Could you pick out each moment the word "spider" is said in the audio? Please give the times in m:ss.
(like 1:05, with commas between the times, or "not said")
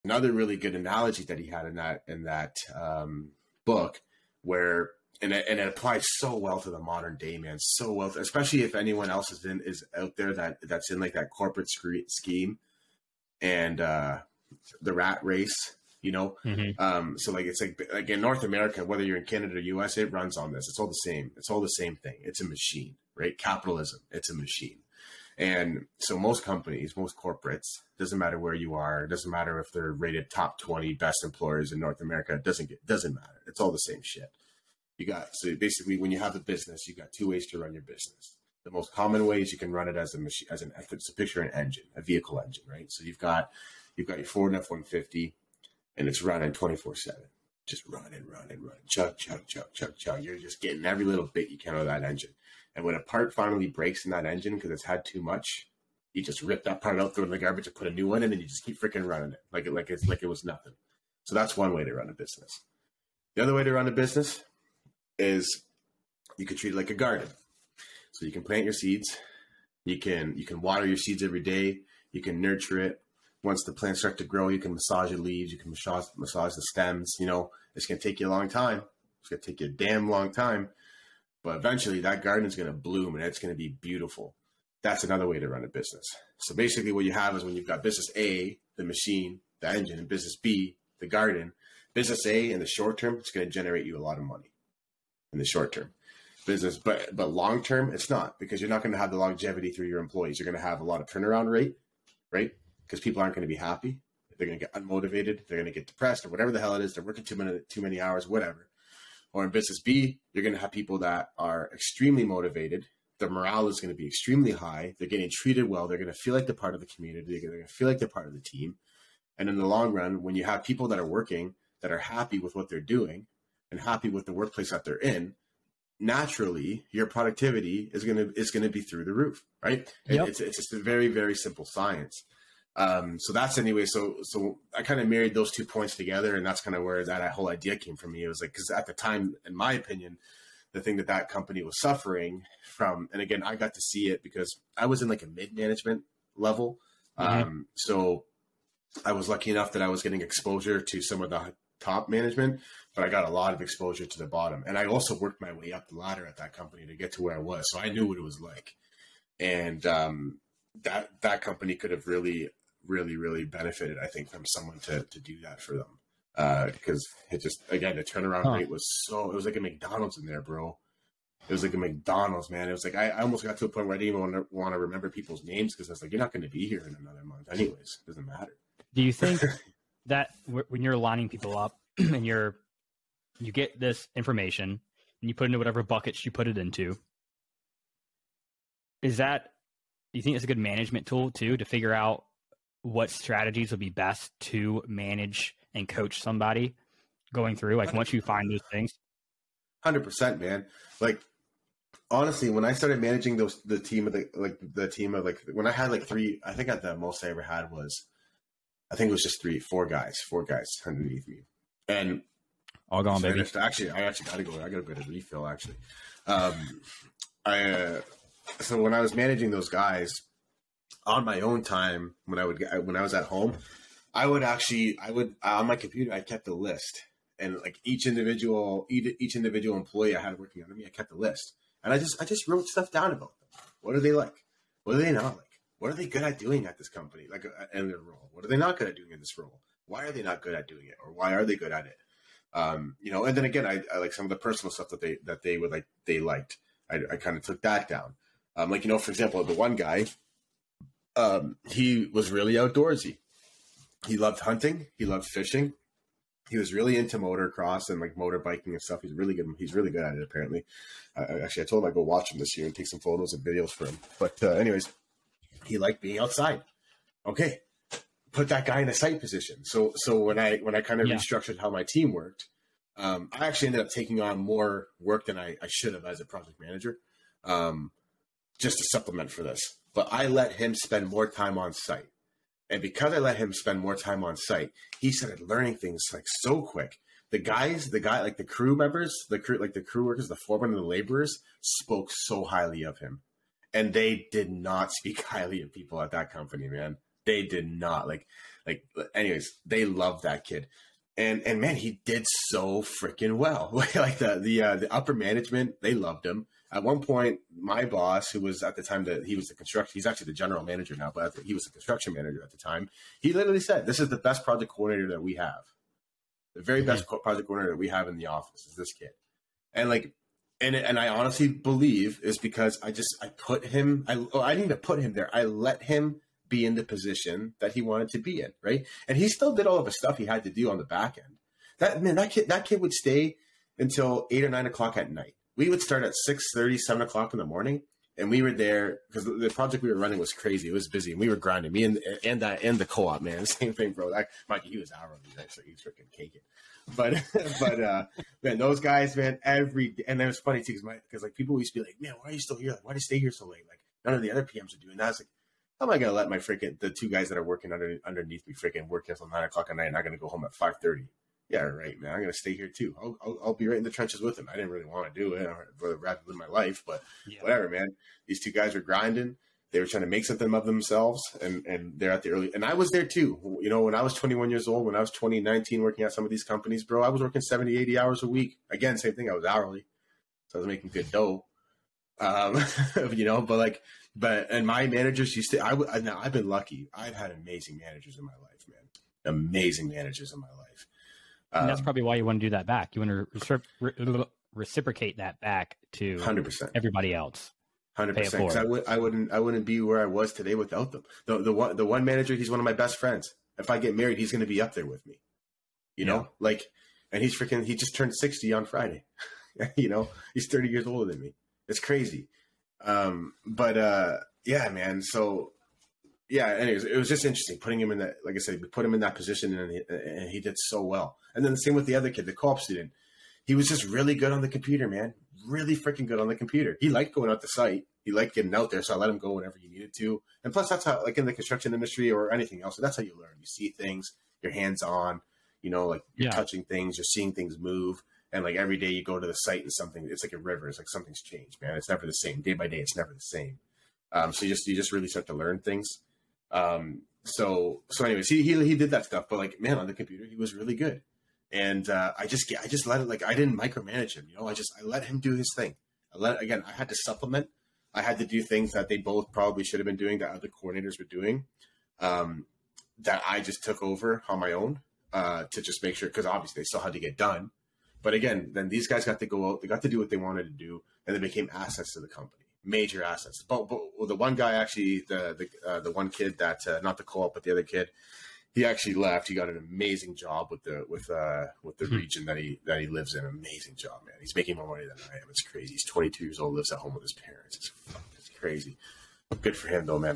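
not said.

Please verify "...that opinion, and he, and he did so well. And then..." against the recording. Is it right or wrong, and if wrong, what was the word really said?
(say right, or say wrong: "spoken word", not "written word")
wrong: "position", not "opinion".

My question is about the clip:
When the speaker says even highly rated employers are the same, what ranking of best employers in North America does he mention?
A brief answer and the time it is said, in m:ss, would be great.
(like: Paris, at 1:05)
top 20, at 0:30.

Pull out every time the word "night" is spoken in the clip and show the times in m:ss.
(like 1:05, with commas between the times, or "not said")
5:35, 5:59.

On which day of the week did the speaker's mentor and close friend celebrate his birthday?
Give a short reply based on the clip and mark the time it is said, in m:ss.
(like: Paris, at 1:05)
Friday, at 6:48.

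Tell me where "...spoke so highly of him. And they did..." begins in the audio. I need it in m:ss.
4:51.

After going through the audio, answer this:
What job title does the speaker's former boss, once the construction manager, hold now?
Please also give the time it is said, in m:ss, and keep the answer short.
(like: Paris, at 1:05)
general manager, at 5:10.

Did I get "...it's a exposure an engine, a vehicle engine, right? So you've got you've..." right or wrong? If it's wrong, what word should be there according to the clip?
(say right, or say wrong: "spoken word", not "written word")
wrong: "picture", not "exposure".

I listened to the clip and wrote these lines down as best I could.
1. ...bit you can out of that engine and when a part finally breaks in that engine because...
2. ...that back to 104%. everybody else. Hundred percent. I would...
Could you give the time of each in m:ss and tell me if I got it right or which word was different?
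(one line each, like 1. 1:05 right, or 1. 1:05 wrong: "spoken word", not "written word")
1. 0:51 right
2. 6:35 wrong: "100", not "104".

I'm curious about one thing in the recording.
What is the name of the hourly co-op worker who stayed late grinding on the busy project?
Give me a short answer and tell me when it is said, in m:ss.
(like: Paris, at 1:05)
Mikey, at 5:44.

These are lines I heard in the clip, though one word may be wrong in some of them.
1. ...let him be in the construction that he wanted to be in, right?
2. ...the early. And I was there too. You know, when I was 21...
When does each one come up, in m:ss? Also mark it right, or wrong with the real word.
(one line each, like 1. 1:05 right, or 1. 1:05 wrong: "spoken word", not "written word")
1. 5:25 wrong: "position", not "construction"
2. 6:12 right.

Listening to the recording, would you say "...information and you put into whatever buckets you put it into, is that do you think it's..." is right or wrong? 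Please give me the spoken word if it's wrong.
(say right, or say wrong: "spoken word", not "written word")
right.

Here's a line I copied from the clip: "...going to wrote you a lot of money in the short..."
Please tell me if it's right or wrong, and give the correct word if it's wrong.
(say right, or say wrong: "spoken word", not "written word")
wrong: "generate", not "wrote".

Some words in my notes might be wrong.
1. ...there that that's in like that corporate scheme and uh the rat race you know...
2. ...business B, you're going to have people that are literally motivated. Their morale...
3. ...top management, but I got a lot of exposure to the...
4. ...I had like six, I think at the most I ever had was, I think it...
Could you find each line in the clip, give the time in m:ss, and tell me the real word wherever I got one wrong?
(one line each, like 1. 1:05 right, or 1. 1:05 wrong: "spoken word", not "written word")
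1. 0:10 right
2. 1:49 wrong: "extremely", not "literally"
3. 2:31 right
4. 3:25 wrong: "three", not "six".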